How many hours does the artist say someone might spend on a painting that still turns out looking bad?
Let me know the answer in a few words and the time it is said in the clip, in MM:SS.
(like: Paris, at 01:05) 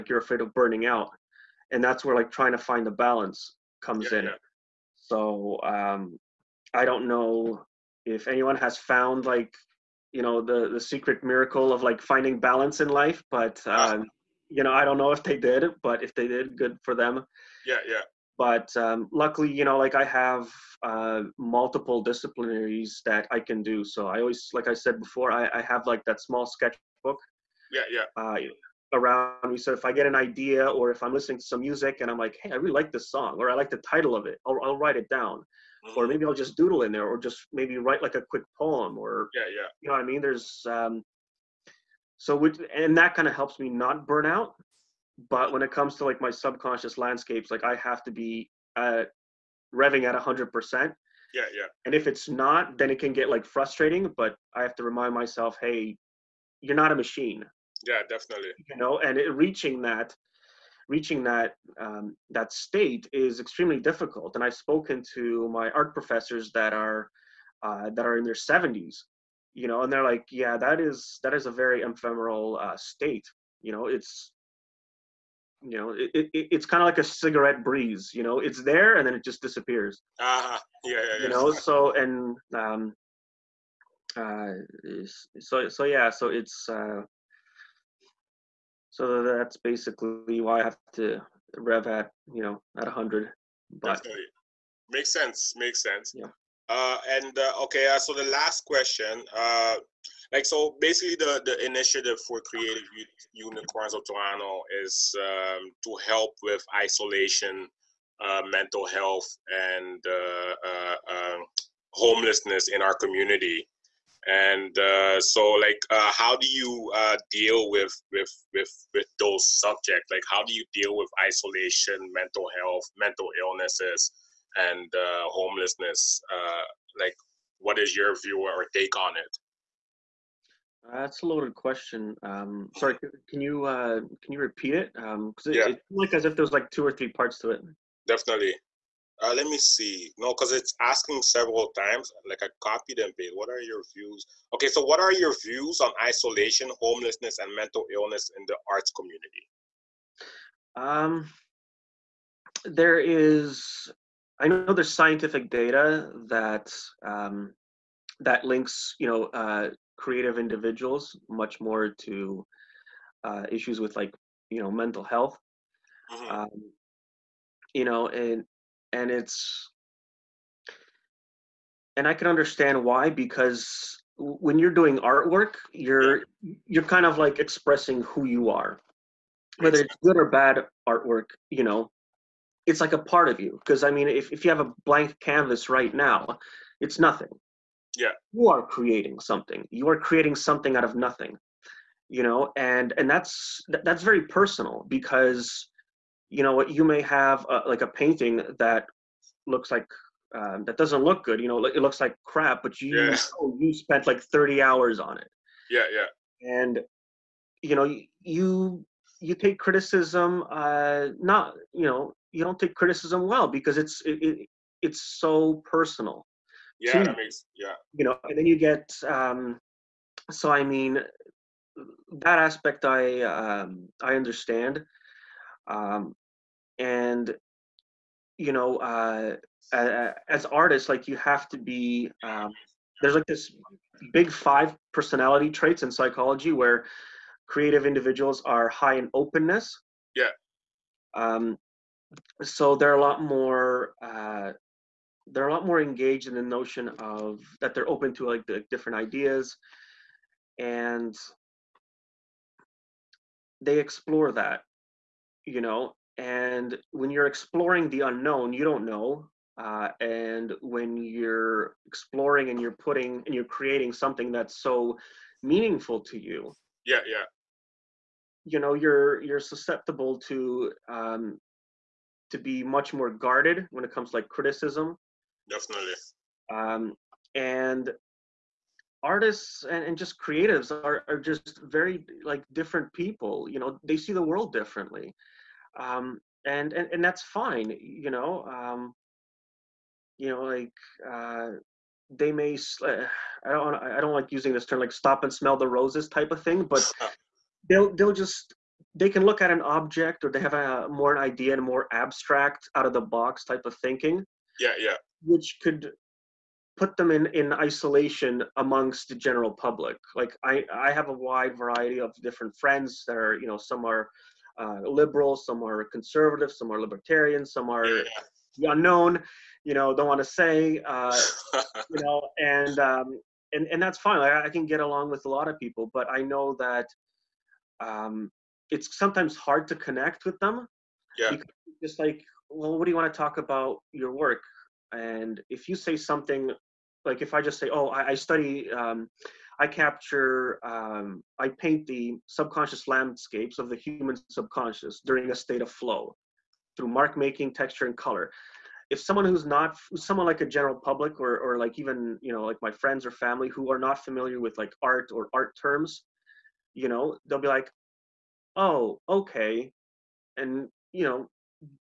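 30, at 03:24.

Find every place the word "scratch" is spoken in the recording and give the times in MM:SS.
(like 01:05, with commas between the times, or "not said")
not said.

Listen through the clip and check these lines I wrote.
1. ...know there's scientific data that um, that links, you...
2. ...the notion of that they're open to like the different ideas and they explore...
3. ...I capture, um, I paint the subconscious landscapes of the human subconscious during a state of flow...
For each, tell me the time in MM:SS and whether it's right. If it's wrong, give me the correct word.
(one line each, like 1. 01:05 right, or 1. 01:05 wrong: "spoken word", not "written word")
1. 02:34 right
2. 04:06 right
3. 05:39 right.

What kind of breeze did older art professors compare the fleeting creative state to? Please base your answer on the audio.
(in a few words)
cigarette breeze.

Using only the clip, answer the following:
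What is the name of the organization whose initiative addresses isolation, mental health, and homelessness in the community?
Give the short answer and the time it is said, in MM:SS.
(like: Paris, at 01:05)
Creative Unicorns of Toronto, at 01:42.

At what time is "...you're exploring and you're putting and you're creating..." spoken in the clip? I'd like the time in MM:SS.
04:20.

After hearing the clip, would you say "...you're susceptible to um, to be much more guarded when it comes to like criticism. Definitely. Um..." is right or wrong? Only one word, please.
right.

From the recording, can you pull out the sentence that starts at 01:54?
And so, like, how do you deal with with with with those subjects?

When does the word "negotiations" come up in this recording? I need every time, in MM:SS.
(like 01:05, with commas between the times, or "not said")
not said.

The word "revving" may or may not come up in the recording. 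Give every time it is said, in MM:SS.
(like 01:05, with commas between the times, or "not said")
00:49.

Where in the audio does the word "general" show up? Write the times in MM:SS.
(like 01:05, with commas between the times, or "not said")
05:09, 05:50.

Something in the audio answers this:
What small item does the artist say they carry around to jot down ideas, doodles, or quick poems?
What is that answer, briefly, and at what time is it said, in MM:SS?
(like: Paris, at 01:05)
sketchbook, at 00:26.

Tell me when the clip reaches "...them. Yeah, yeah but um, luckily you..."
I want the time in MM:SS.
00:16.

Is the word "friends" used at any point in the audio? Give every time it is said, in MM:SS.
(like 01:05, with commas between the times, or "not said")
05:12, 05:52.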